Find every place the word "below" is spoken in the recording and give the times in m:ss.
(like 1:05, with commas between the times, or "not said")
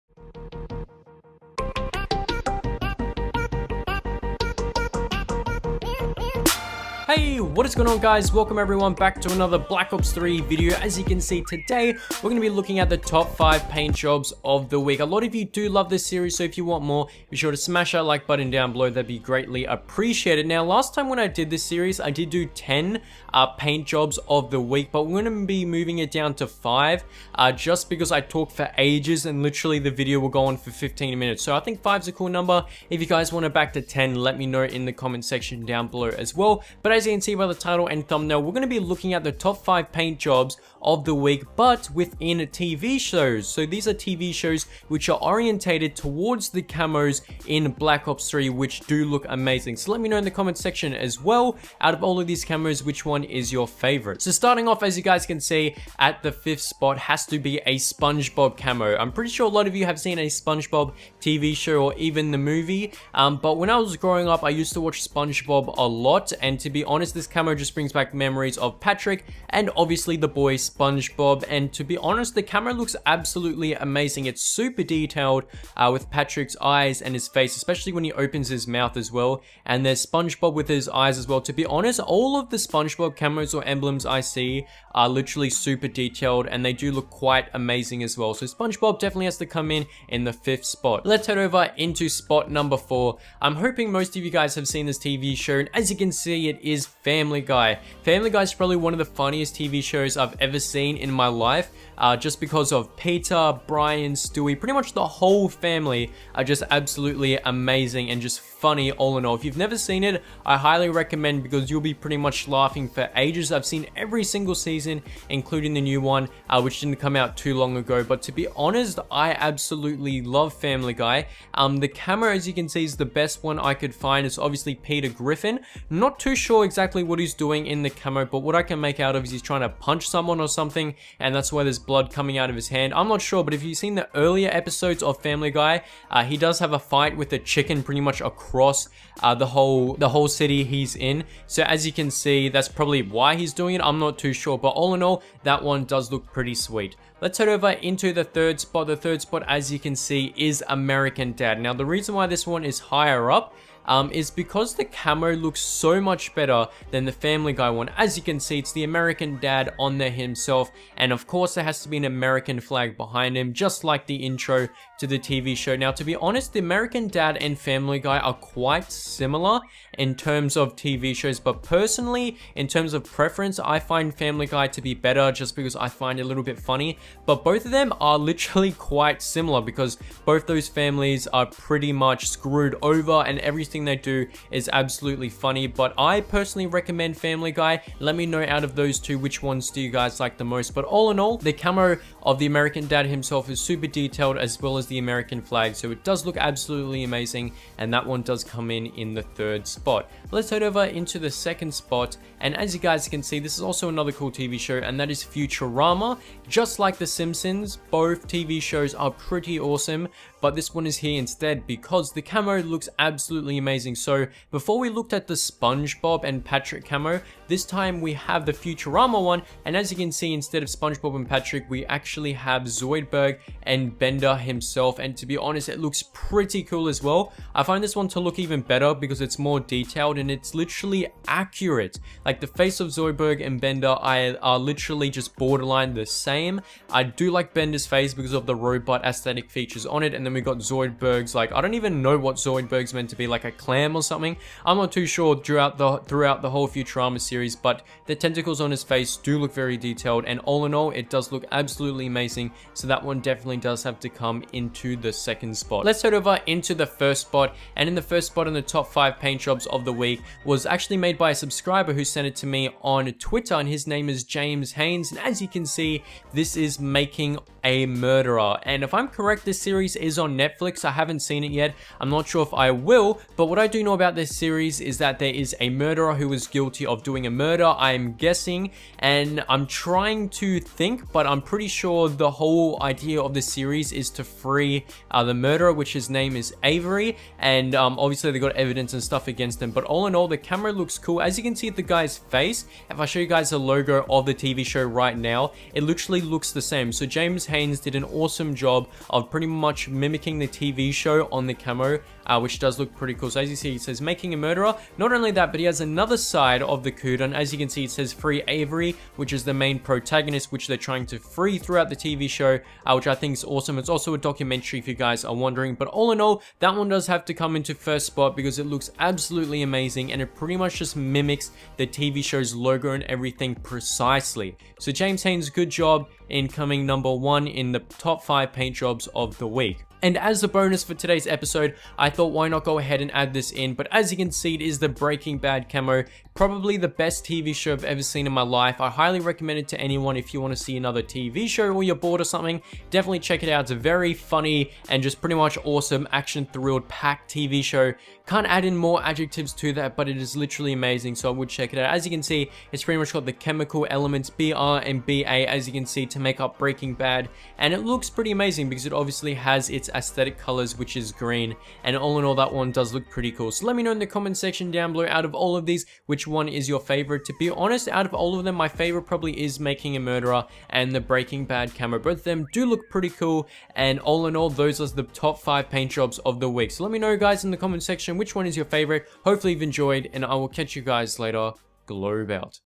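0:18, 0:35, 6:04.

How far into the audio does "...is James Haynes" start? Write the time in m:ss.
4:24.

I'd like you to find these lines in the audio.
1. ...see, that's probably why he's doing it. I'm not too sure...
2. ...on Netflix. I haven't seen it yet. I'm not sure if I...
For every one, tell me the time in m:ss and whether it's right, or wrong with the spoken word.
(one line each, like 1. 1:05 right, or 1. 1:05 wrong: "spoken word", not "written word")
1. 2:22 right
2. 4:30 right.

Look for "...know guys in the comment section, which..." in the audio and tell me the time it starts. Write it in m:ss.
6:16.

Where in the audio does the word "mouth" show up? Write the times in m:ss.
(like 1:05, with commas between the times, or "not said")
1:18.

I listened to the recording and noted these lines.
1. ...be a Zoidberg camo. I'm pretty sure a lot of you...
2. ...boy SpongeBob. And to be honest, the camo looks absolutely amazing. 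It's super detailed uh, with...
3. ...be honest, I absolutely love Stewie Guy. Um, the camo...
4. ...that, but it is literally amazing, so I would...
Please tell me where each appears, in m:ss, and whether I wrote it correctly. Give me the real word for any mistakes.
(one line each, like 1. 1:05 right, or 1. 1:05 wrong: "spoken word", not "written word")
1. 0:57 wrong: "SpongeBob", not "Zoidberg"
2. 1:10 right
3. 1:58 wrong: "Family", not "Stewie"
4. 5:49 right.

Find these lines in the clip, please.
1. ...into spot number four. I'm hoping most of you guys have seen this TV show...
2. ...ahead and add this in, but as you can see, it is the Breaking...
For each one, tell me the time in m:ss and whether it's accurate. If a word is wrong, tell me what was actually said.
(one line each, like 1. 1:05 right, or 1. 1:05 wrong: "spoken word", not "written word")
1. 1:31 right
2. 5:32 right.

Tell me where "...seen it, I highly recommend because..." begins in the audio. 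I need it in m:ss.
1:49.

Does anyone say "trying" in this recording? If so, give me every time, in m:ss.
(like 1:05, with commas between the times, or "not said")
2:09, 4:39, 5:10.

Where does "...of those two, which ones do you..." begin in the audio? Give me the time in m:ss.
3:08.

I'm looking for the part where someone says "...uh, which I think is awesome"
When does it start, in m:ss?
5:12.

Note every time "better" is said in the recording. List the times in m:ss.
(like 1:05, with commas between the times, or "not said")
2:36, 2:54, 3:48.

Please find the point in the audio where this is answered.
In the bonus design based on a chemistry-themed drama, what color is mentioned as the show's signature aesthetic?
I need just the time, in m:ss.
6:01.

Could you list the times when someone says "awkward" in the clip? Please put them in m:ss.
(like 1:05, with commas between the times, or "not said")
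not said.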